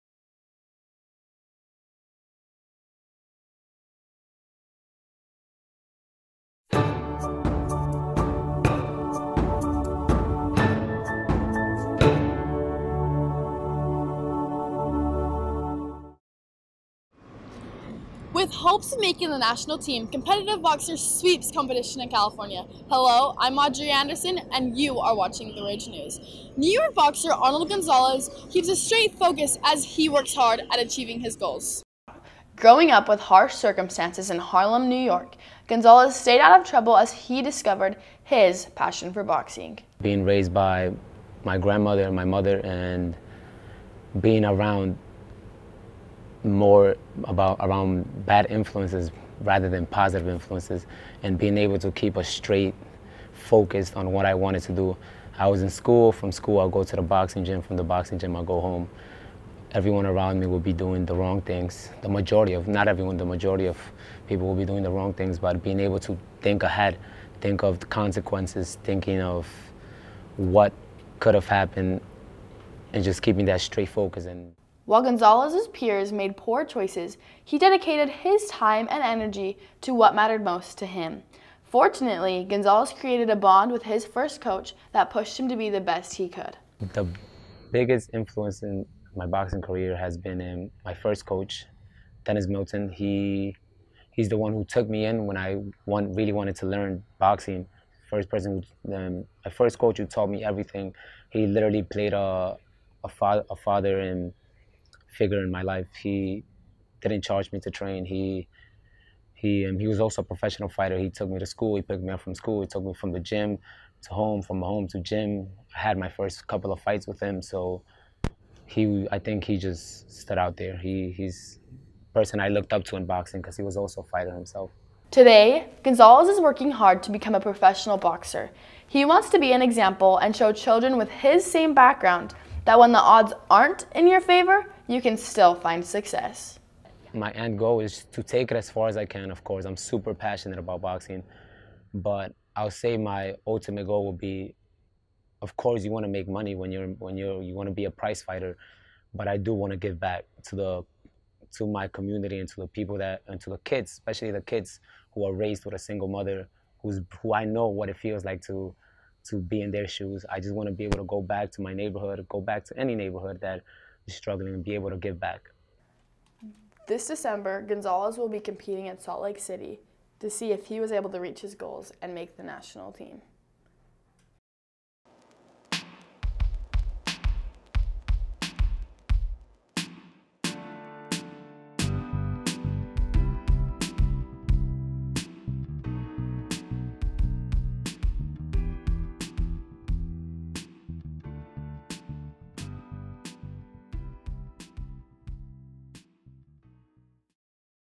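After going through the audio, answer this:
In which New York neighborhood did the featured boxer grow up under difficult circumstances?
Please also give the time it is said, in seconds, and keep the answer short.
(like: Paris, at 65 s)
Harlem, at 34 s.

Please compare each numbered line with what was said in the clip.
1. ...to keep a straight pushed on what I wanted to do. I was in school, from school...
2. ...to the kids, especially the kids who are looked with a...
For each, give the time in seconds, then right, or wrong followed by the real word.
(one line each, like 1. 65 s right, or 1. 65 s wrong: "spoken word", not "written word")
1. 51 s wrong: "focused", not "pushed"
2. 153 s wrong: "raised", not "looked".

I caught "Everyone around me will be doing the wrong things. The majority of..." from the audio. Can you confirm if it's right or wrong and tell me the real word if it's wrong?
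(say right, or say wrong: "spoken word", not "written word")
right.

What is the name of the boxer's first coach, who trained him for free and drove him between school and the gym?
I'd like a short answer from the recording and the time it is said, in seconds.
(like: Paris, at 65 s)
Dennis Milton, at 92 s.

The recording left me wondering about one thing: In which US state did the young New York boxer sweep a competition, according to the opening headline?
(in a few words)
California.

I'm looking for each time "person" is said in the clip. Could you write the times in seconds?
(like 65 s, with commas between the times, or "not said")
98 s, 122 s.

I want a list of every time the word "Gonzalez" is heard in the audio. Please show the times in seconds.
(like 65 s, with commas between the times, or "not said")
27 s, 35 s, 75 s, 82 s, 125 s, 167 s.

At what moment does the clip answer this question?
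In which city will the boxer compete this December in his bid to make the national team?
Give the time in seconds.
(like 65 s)
168 s.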